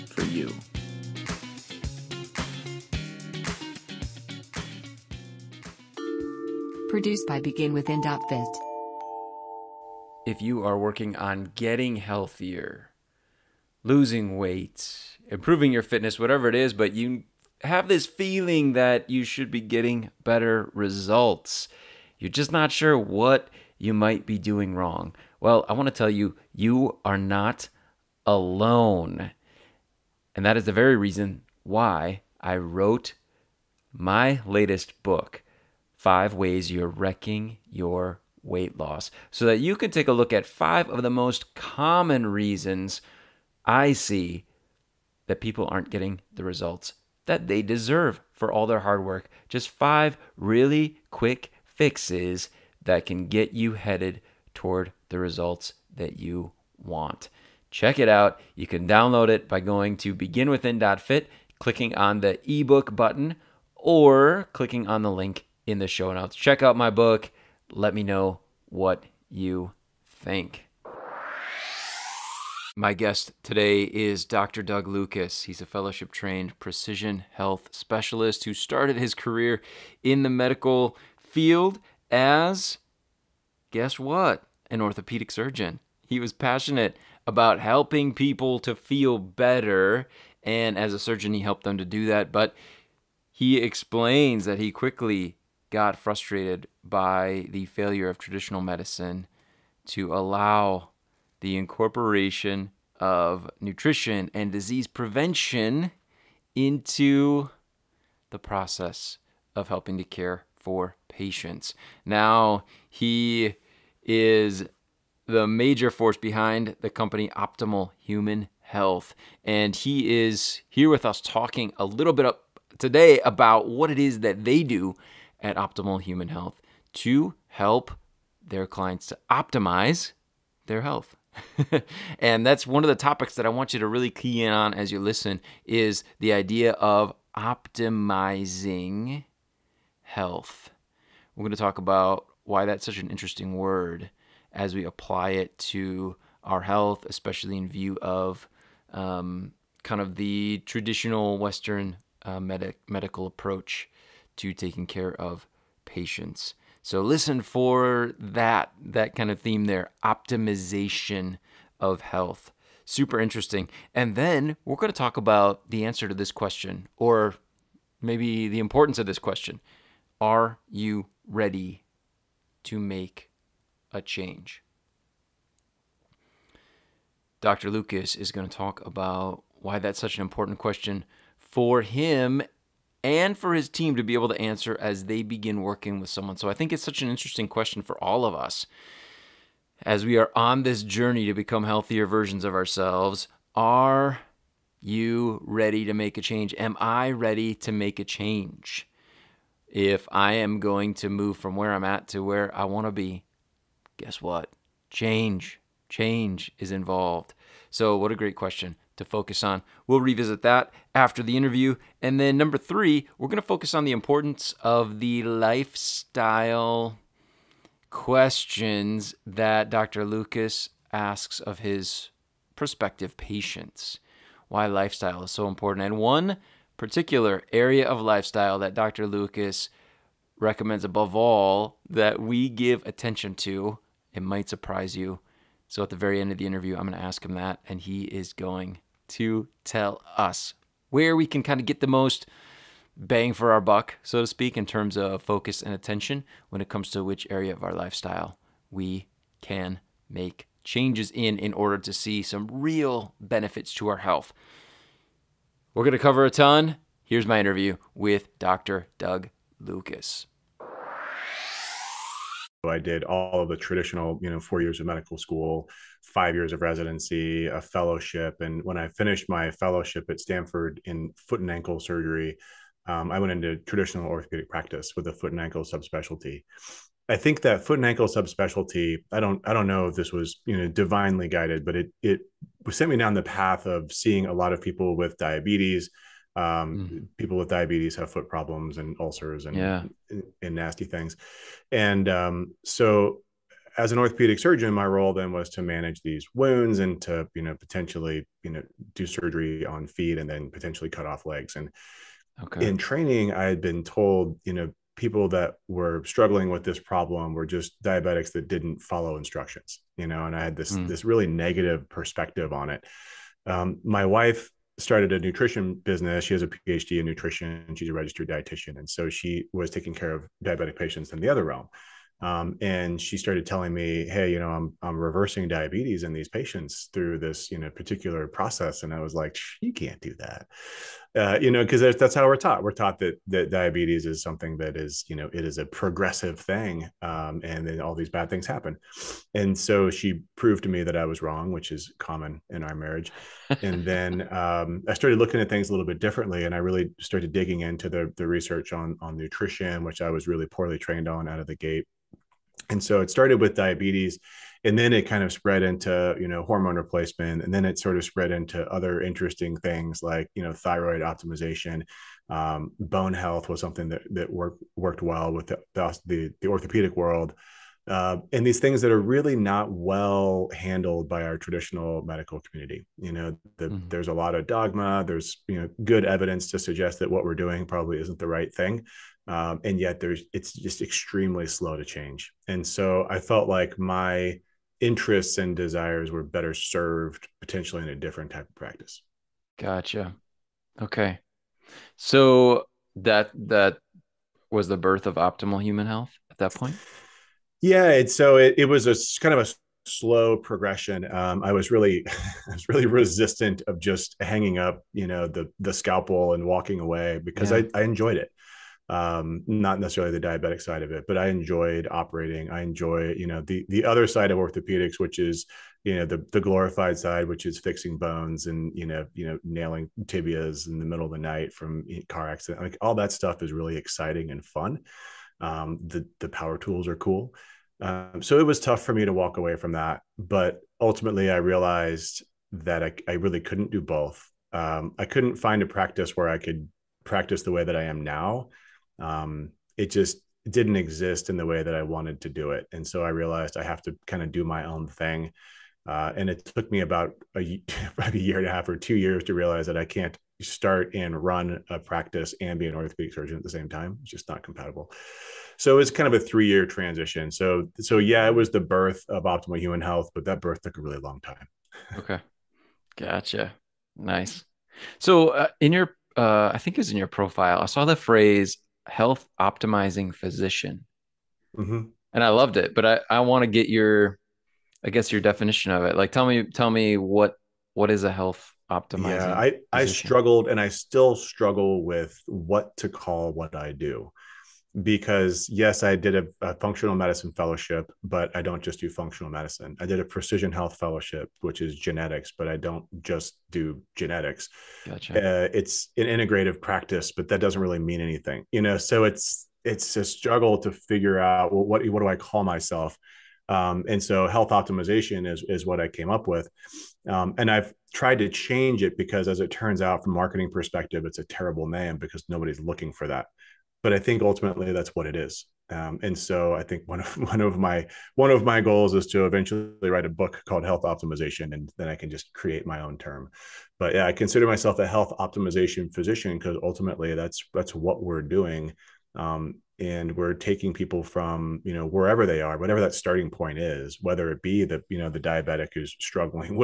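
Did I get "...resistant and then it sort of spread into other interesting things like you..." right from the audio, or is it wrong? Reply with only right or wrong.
wrong.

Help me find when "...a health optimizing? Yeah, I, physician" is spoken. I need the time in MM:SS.
07:58.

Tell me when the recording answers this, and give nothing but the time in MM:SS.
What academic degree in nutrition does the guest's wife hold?
05:16.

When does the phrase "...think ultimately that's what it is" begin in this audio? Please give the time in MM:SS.
08:33.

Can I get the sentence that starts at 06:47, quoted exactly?
I, I enjoyed it um, not necessarily the diabetic side of it, but I enjoyed operating.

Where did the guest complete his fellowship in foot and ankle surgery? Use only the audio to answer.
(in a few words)
Stanford.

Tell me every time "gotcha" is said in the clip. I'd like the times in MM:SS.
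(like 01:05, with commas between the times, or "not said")
06:29, 07:42, 08:14.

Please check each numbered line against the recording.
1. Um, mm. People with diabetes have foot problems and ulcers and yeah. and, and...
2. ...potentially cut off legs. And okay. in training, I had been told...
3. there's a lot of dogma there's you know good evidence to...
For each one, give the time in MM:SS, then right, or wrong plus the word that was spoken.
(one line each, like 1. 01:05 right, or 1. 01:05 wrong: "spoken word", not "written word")
1. 04:46 right
2. 05:00 right
3. 06:13 right.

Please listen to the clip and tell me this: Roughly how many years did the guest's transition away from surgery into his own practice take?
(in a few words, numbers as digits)
3.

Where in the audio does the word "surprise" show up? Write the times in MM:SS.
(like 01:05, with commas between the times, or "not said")
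03:54.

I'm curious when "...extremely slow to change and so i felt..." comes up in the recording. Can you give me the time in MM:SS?
06:20.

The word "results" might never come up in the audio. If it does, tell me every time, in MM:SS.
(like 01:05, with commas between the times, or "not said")
00:20, 00:46, 00:55.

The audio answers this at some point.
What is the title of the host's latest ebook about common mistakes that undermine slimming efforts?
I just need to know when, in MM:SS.
00:35.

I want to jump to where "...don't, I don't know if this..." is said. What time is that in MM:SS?
04:39.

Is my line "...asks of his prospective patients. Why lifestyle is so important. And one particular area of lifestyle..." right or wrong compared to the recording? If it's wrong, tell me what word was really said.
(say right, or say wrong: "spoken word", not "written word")
right.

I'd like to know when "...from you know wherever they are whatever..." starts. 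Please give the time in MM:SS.
08:51.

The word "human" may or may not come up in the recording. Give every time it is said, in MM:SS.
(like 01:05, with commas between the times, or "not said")
01:58, 02:06, 06:35, 07:39.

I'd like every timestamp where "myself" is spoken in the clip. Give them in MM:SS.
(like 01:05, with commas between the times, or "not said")
08:22, 08:44.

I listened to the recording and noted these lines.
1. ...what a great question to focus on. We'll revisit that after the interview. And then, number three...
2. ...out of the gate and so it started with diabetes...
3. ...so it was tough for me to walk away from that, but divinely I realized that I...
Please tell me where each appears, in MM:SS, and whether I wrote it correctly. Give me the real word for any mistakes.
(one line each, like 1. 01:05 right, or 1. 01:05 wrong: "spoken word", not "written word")
1. 03:27 right
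2. 05:51 right
3. 07:08 wrong: "ultimately", not "divinely".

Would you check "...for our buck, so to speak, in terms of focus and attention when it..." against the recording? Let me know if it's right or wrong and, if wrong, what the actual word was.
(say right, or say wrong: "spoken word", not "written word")
right.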